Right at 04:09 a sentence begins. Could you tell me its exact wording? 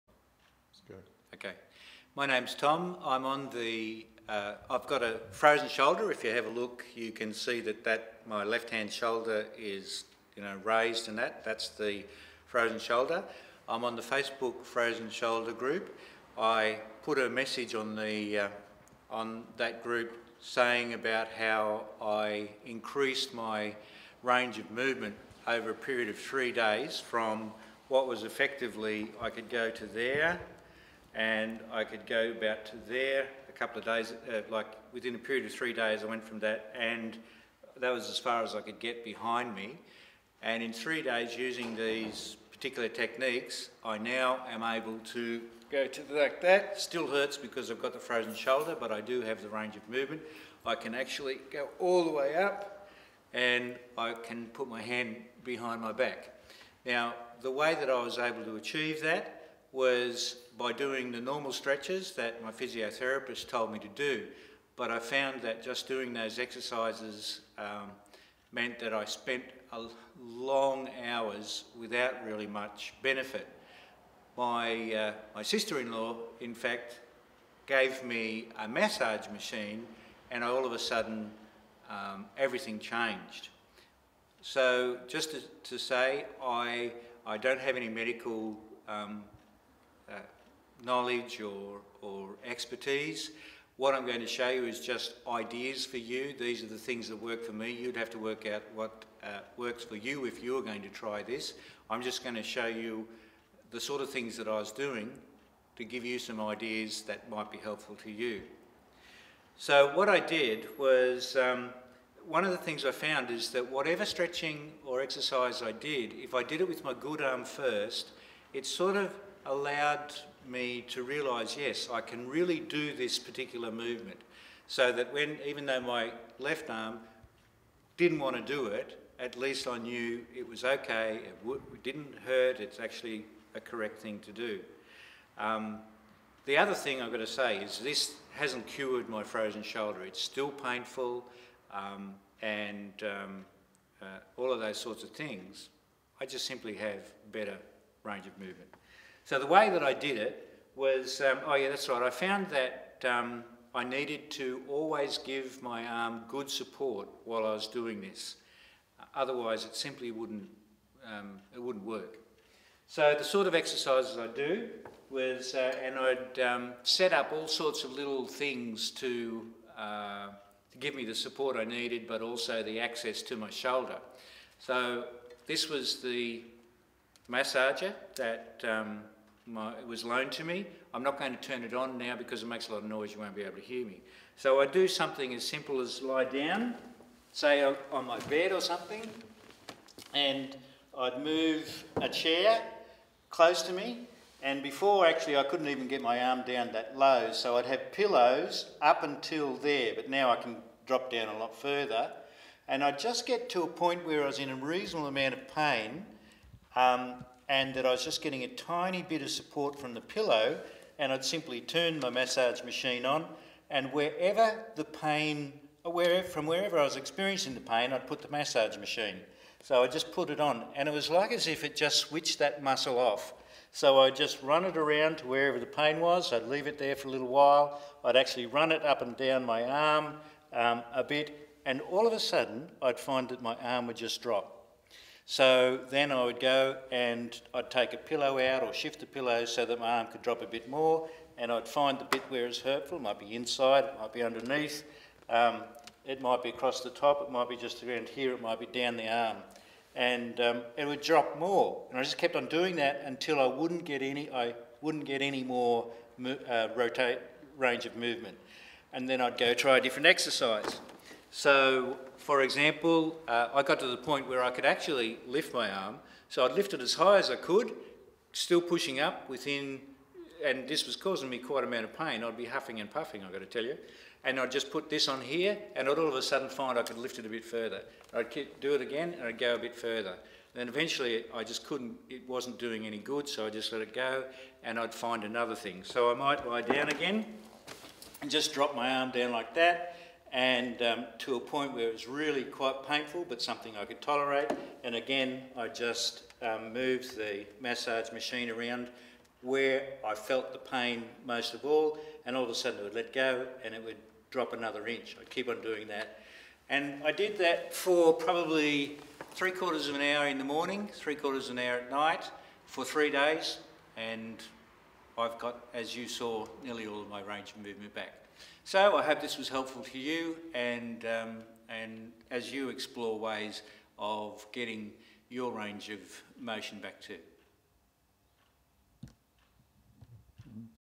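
And um, it would drop more.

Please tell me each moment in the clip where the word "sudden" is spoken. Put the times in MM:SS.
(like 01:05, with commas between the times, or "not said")
01:20, 03:52, 04:36, 05:02.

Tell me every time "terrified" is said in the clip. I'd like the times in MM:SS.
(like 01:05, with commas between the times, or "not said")
not said.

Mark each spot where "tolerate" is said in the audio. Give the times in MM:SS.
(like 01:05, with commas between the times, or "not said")
04:54.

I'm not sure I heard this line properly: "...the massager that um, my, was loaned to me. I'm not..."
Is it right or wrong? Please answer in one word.
right.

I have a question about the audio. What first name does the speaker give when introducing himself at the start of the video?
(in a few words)
Tom.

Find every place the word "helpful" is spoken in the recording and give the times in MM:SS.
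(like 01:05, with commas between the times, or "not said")
01:47, 05:19.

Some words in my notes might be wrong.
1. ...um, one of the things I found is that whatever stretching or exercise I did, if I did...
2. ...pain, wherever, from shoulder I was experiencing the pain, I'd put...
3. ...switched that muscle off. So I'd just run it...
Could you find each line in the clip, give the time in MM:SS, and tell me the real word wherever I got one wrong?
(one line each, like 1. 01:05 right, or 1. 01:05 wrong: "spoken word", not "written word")
1. 01:51 right
2. 03:34 wrong: "wherever", not "shoulder"
3. 03:41 right.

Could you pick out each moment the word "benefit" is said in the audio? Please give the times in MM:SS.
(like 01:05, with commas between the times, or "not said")
01:13.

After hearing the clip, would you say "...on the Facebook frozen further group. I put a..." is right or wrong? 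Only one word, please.
wrong.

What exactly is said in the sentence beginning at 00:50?
I can actually go all the way up, and I can put my hand behind my back.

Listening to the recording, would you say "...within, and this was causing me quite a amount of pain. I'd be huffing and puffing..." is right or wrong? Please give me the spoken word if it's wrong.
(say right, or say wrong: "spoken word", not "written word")
right.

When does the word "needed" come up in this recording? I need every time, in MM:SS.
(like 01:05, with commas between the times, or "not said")
02:33, 02:51.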